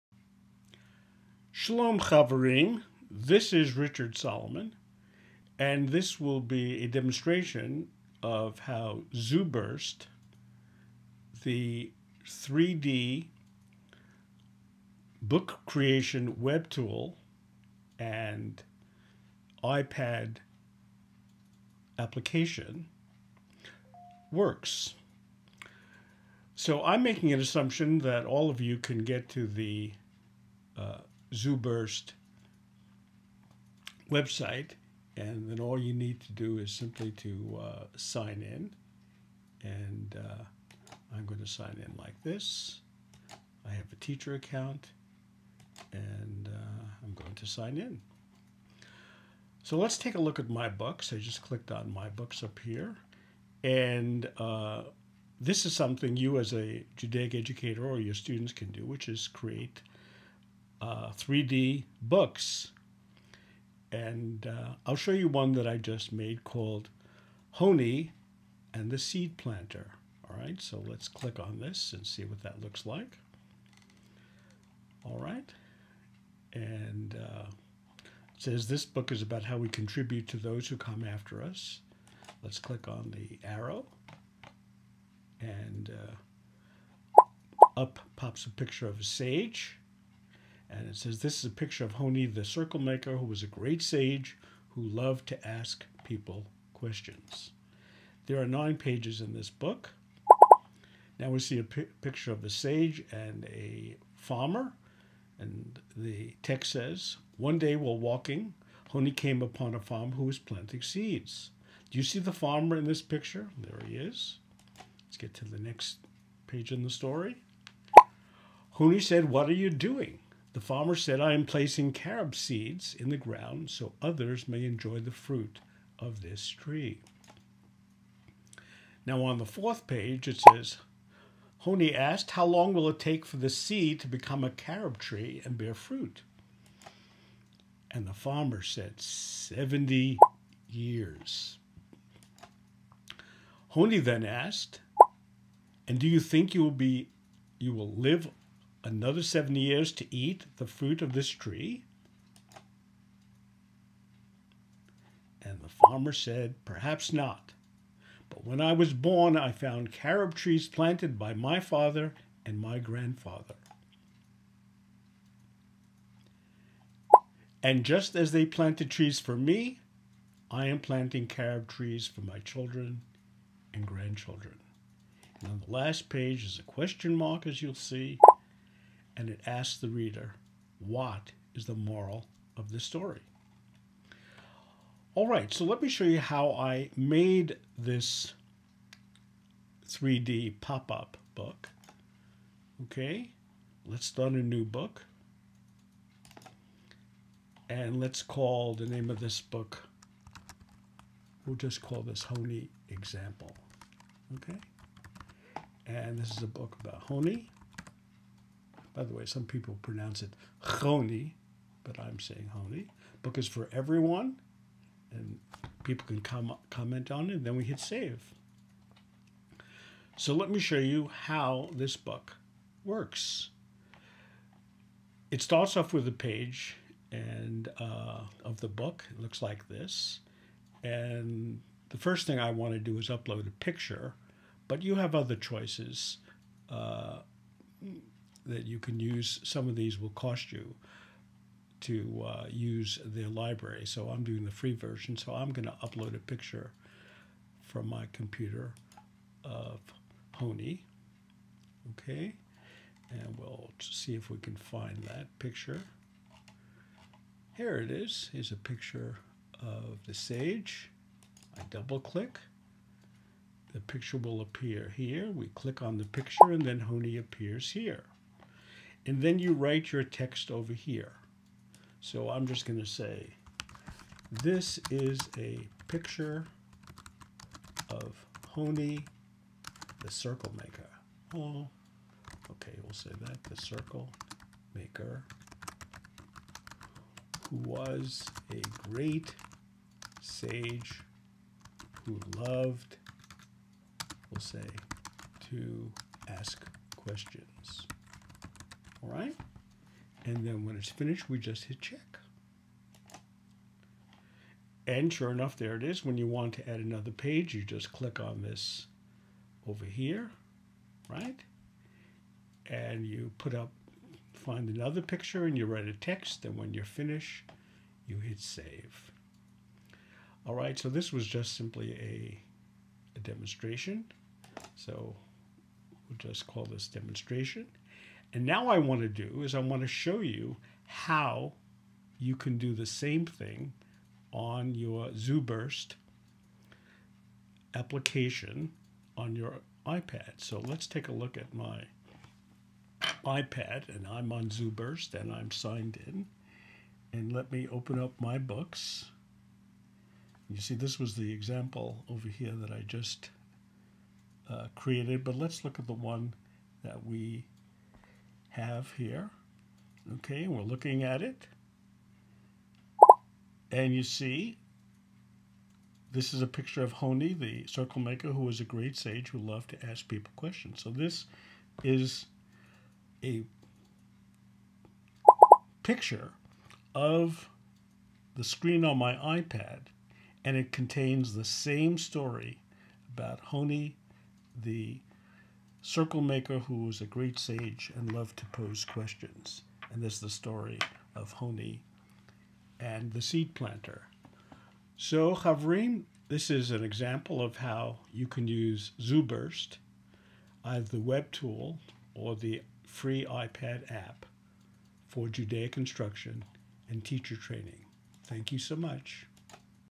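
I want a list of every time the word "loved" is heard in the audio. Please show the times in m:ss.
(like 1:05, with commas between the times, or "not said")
1:34, 4:52, 6:09, 6:28.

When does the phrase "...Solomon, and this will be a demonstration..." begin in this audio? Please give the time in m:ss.
0:04.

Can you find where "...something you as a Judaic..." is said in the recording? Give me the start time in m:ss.
0:55.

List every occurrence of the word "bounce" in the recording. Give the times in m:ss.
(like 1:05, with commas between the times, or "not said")
not said.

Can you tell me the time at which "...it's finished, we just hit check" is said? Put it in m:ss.
5:00.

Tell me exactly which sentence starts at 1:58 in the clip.
Honi said, What are you doing?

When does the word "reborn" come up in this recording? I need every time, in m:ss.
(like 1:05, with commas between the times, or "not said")
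not said.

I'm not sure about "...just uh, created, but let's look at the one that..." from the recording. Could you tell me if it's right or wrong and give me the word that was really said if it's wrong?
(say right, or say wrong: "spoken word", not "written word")
right.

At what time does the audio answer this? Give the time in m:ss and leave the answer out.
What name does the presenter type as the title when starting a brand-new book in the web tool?
3:22.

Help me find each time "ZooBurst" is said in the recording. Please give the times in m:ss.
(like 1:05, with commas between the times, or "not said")
0:09, 0:31, 5:35, 5:44, 6:38.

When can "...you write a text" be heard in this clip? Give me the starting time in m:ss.
5:15.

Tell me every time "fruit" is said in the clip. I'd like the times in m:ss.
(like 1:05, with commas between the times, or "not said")
2:05, 2:15, 2:30.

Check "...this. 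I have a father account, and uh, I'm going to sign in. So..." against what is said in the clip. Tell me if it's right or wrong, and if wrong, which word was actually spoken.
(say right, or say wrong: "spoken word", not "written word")
wrong: "teacher", not "father".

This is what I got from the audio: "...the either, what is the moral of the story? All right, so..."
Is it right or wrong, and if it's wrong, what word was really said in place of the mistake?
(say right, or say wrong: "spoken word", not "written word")
wrong: "reader", not "either".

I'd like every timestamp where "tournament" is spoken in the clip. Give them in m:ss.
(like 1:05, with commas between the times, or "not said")
not said.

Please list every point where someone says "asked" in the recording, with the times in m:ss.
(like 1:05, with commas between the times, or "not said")
2:11, 2:24.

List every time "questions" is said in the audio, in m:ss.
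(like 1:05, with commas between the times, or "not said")
1:36, 2:56, 4:56, 6:10, 6:28.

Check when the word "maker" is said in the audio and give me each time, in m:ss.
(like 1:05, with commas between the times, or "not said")
1:32, 4:40, 4:44, 6:08, 6:26.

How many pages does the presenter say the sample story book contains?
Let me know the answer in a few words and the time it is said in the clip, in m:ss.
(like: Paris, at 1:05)
Nine, at 1:38.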